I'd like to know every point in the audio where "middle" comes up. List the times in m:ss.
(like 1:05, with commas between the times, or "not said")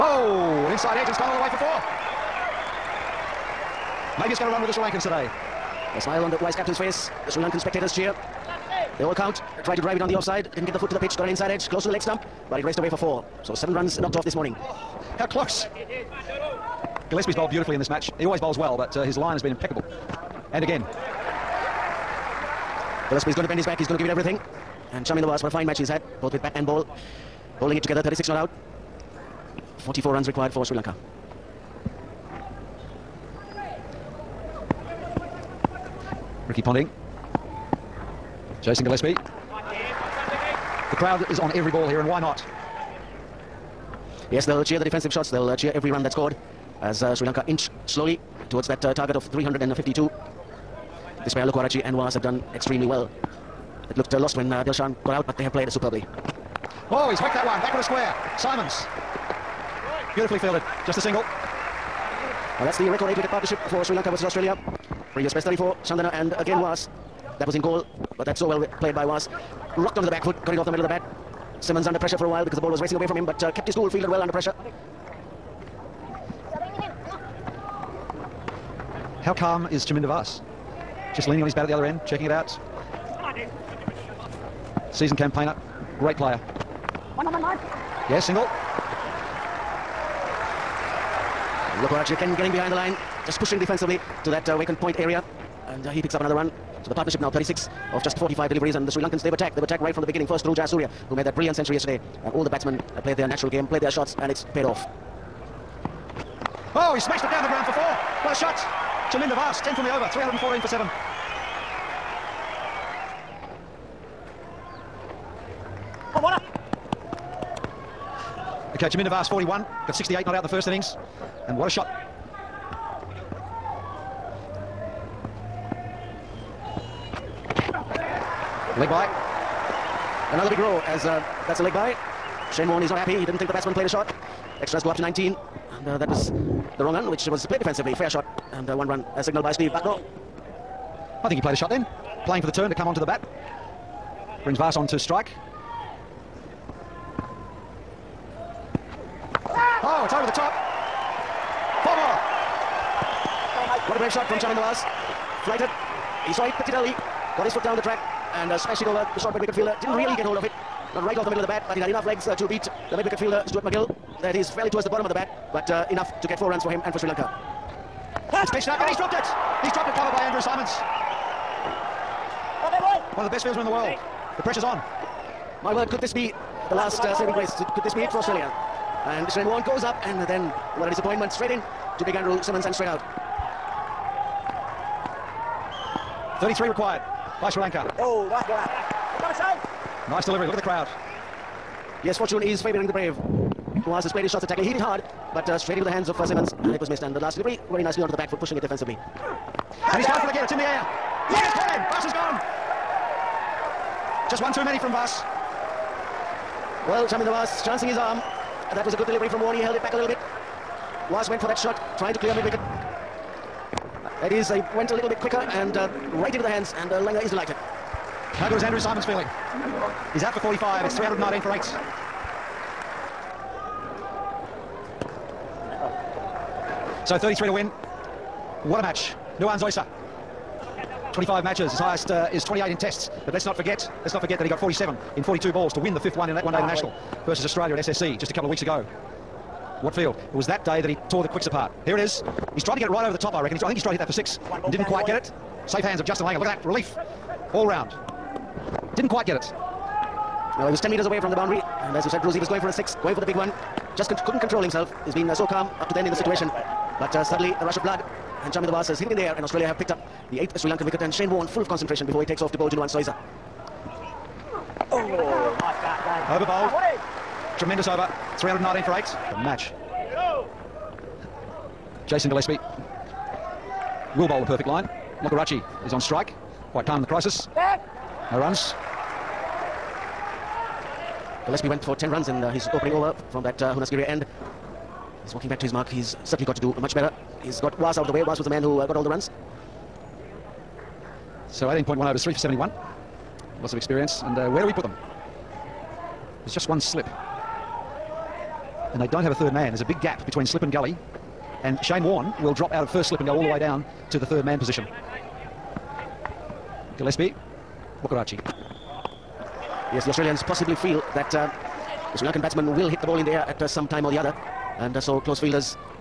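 1:10, 2:41.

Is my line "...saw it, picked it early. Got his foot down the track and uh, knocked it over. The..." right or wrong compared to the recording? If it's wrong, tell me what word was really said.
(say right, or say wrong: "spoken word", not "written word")
wrong: "smashed", not "knocked".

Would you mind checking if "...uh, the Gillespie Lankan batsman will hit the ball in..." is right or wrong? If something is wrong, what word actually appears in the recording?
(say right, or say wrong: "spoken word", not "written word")
wrong: "Sri", not "Gillespie".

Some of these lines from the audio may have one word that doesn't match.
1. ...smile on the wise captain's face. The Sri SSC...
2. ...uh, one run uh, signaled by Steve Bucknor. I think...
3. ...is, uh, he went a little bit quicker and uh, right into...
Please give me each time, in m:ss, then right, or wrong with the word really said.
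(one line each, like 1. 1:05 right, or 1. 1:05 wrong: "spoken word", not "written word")
1. 0:06 wrong: "Lankan", not "SSC"
2. 2:18 right
3. 3:34 right.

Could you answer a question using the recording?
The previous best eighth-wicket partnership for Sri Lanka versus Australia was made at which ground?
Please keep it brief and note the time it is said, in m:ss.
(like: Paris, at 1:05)
Galle, at 1:07.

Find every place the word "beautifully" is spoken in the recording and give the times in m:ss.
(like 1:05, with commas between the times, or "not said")
0:17, 1:00.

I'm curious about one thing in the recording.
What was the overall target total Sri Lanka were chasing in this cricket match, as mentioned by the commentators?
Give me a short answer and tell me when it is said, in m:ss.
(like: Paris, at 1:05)
352, at 0:49.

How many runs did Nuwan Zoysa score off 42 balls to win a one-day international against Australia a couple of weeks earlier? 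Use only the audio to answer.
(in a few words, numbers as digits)
47.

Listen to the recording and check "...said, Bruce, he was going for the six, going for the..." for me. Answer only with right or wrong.
right.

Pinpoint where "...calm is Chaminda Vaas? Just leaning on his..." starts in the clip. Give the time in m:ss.
1:19.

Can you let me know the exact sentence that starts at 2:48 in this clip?
It's pitched up and he's dropped it.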